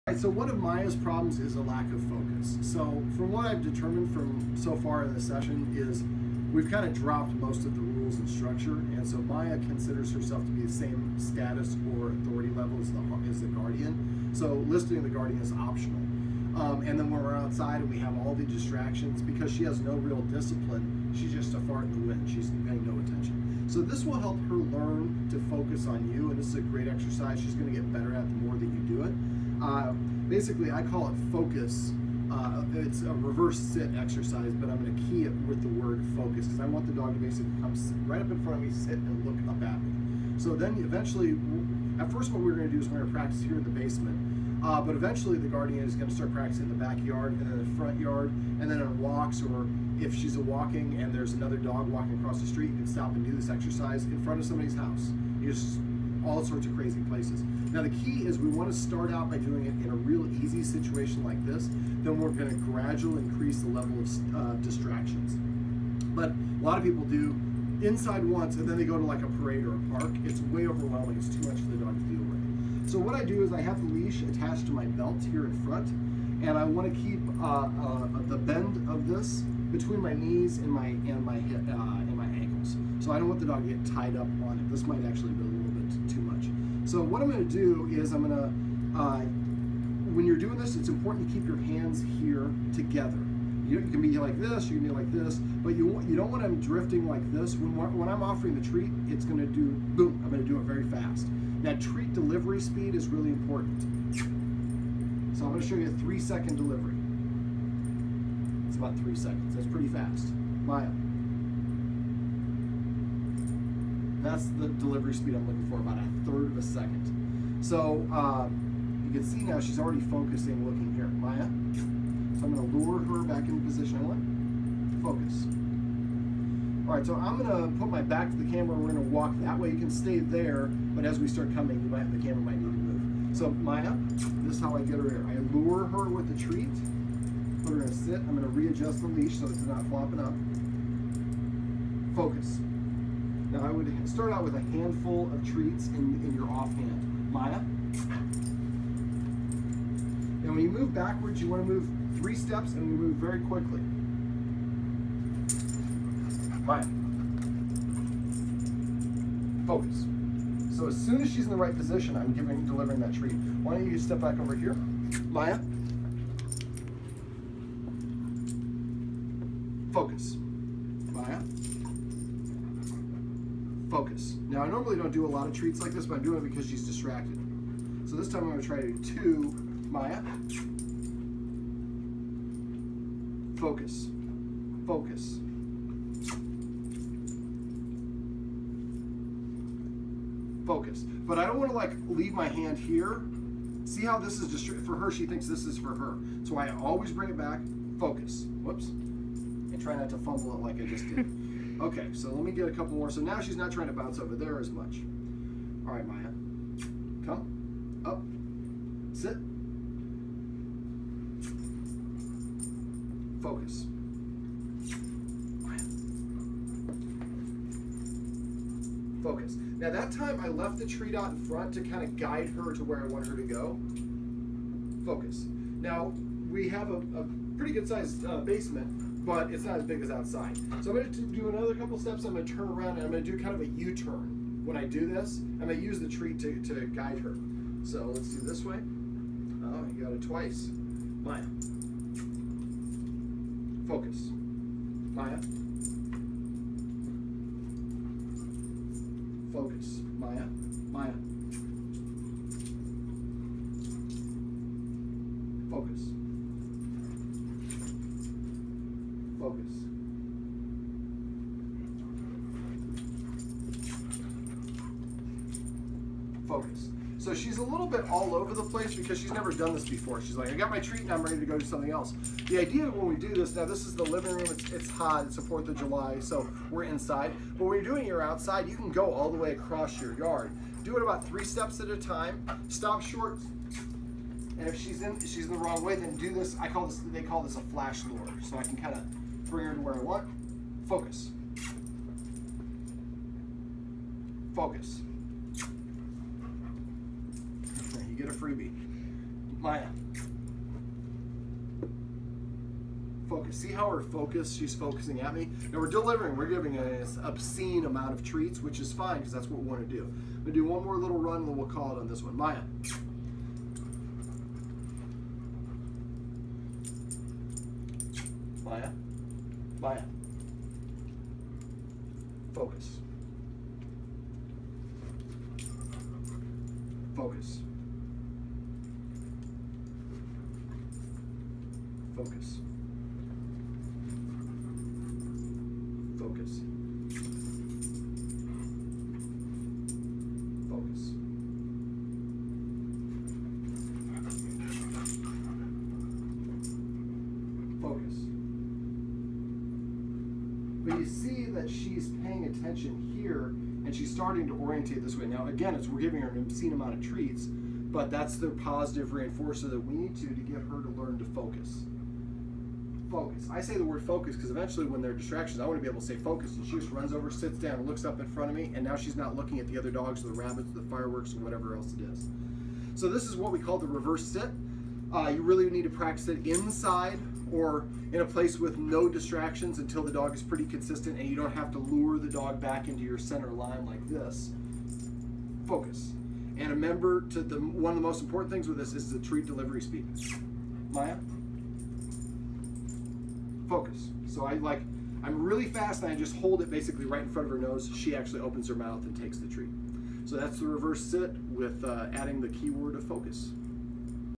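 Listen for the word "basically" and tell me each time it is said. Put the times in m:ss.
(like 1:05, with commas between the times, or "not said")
0:30, 0:37, 6:36.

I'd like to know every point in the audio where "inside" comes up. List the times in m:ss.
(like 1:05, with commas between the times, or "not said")
1:07, 4:36, 6:16.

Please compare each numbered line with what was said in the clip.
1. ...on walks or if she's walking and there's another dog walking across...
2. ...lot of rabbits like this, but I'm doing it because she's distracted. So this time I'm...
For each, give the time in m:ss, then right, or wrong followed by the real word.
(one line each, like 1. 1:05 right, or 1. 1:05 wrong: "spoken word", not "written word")
1. 0:48 right
2. 2:55 wrong: "treats", not "rabbits".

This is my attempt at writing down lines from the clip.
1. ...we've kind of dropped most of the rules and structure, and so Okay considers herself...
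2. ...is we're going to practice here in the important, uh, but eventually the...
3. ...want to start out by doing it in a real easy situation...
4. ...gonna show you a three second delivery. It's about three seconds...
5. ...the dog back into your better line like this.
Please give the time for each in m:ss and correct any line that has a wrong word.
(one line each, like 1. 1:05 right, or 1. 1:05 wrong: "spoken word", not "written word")
1. 0:06 wrong: "Maya", not "Okay"
2. 0:42 wrong: "basement", not "important"
3. 0:58 right
4. 1:45 right
5. 6:22 wrong: "center", not "better".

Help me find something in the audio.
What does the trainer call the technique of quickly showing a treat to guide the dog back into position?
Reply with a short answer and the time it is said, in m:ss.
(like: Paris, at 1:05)
Flash lure, at 4:47.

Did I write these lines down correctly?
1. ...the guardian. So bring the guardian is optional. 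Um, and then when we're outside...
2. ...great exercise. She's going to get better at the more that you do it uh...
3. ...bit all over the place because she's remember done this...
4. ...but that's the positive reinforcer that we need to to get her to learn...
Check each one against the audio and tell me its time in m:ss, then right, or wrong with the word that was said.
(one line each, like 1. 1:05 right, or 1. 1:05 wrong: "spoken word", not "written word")
1. 0:13 wrong: "listing", not "bring"
2. 0:26 right
3. 4:27 wrong: "never", not "remember"
4. 5:57 right.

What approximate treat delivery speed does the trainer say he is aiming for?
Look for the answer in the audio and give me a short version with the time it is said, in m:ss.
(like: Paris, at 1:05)
About a third of a second, at 1:55.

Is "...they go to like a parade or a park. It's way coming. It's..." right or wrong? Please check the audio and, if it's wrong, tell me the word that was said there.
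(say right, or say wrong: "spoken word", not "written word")
wrong: "overwhelming", not "coming".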